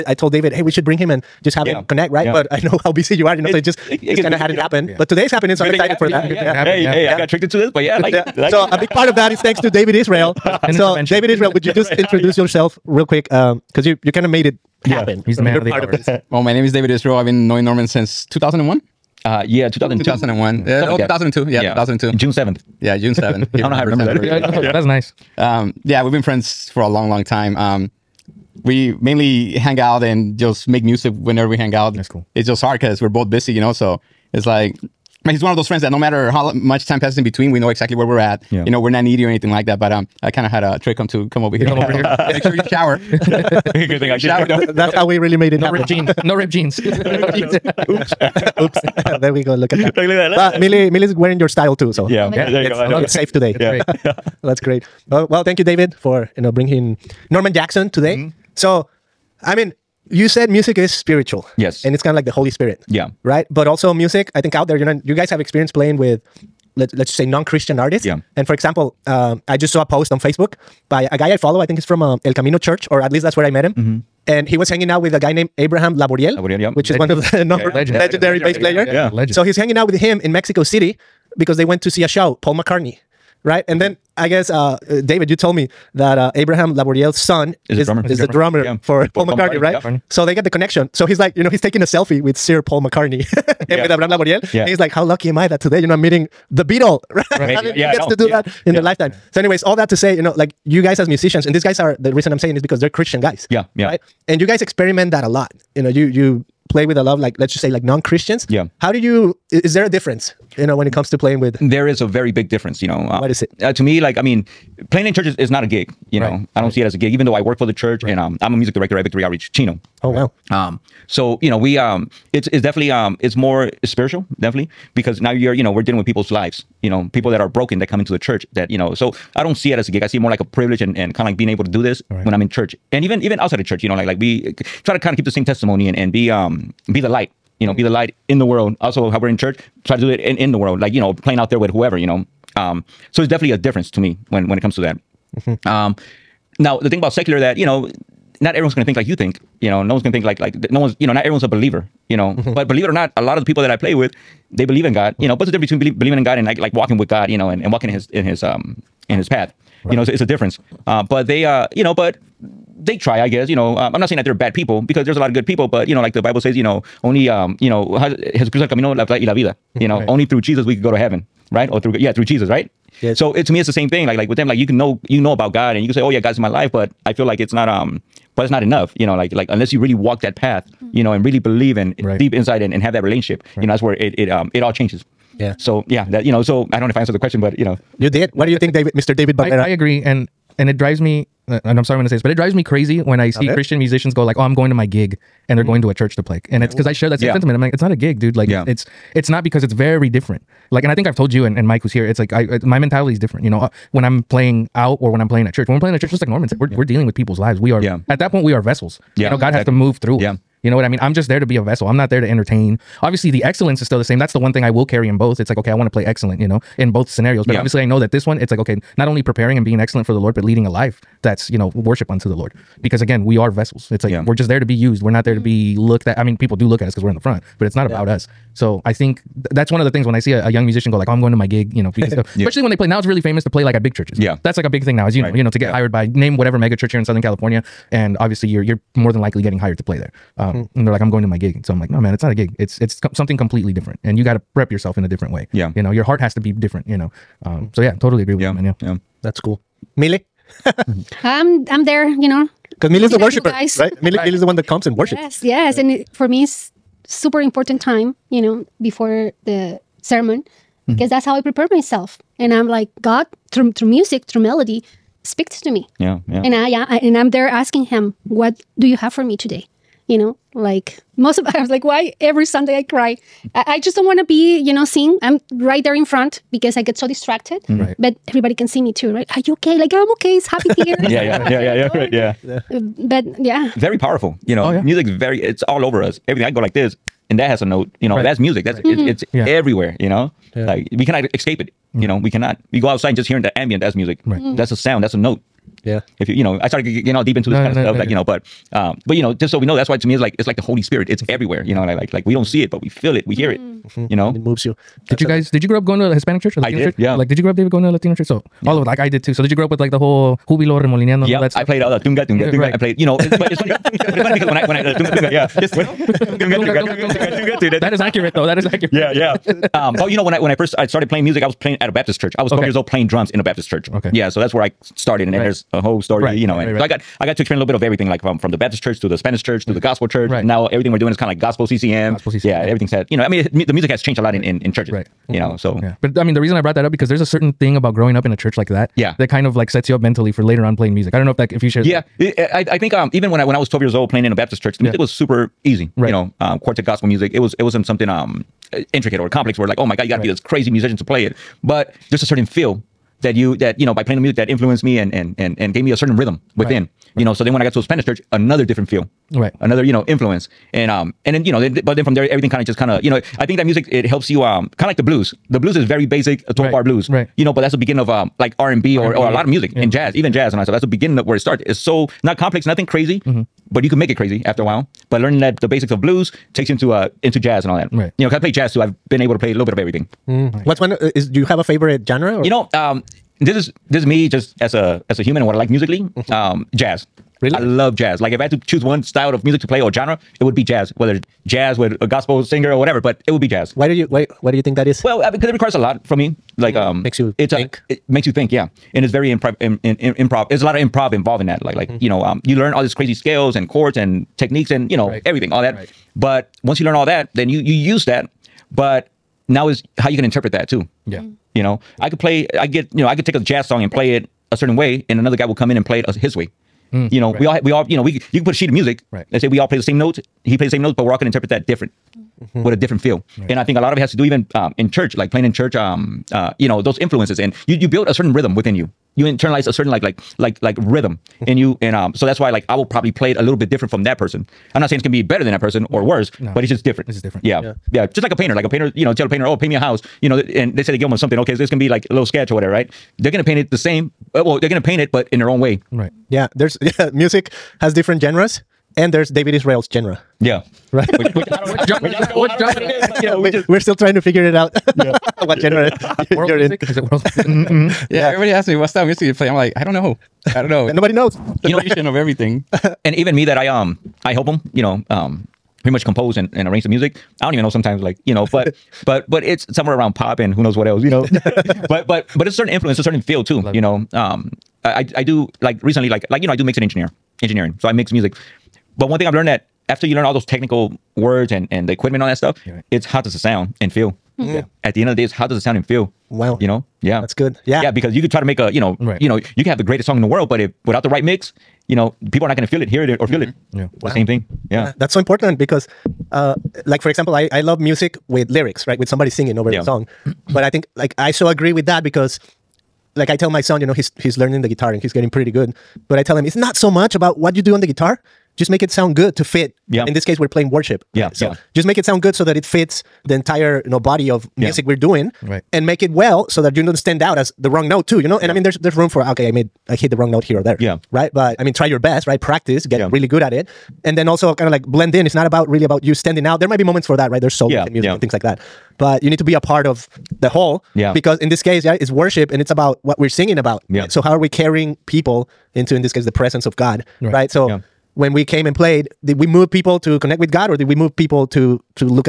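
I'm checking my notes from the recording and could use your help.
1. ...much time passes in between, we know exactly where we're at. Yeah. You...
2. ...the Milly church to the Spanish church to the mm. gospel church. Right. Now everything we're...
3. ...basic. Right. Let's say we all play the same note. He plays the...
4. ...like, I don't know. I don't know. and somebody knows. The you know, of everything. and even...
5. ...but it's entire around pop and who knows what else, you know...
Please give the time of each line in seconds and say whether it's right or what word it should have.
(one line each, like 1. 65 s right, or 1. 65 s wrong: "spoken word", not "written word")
1. 36 s right
2. 328 s wrong: "Baptist", not "Milly"
3. 418 s wrong: "music", not "basic"
4. 459 s wrong: "nobody", not "somebody"
5. 469 s wrong: "somewhere", not "entire".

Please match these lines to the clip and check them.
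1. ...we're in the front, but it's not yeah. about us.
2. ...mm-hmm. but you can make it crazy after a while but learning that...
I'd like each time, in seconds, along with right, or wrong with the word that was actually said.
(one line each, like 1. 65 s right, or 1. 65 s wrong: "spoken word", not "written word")
1. 227 s right
2. 373 s right.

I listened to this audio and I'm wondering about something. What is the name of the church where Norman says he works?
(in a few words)
Victory Outreach Chino.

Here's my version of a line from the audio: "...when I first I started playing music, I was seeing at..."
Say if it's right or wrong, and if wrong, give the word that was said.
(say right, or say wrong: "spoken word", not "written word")
wrong: "playing", not "seeing".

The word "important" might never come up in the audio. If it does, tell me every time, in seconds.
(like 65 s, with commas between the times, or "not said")
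257 s, 495 s.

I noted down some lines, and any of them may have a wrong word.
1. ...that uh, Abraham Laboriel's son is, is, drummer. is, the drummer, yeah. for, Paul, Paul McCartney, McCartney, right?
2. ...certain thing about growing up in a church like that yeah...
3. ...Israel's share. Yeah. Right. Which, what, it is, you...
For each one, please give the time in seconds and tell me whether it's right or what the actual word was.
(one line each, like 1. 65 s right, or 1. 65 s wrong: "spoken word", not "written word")
1. 85 s right
2. 337 s right
3. 449 s wrong: "genre", not "share".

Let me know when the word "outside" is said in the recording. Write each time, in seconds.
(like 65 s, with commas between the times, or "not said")
133 s, 292 s.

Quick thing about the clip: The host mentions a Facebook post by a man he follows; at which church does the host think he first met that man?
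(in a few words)
El Camino Church.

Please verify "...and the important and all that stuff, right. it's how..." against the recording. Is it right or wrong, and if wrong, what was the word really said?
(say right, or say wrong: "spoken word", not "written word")
wrong: "equipment", not "important".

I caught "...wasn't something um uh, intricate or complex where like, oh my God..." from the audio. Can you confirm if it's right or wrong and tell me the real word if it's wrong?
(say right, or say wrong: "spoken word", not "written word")
right.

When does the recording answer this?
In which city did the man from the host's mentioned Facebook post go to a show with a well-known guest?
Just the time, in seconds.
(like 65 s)
80 s.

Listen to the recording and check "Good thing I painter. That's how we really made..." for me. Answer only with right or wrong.
wrong.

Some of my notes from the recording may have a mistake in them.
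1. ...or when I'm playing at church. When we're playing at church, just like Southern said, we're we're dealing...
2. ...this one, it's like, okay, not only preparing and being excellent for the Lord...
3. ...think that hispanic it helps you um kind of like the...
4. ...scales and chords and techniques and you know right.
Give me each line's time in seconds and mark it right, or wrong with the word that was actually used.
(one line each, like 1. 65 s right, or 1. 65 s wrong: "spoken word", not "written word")
1. 204 s wrong: "Norman", not "Southern"
2. 218 s right
3. 363 s wrong: "music", not "hispanic"
4. 403 s right.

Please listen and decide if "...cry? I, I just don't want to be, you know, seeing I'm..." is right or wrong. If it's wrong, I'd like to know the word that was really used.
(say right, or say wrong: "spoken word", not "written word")
right.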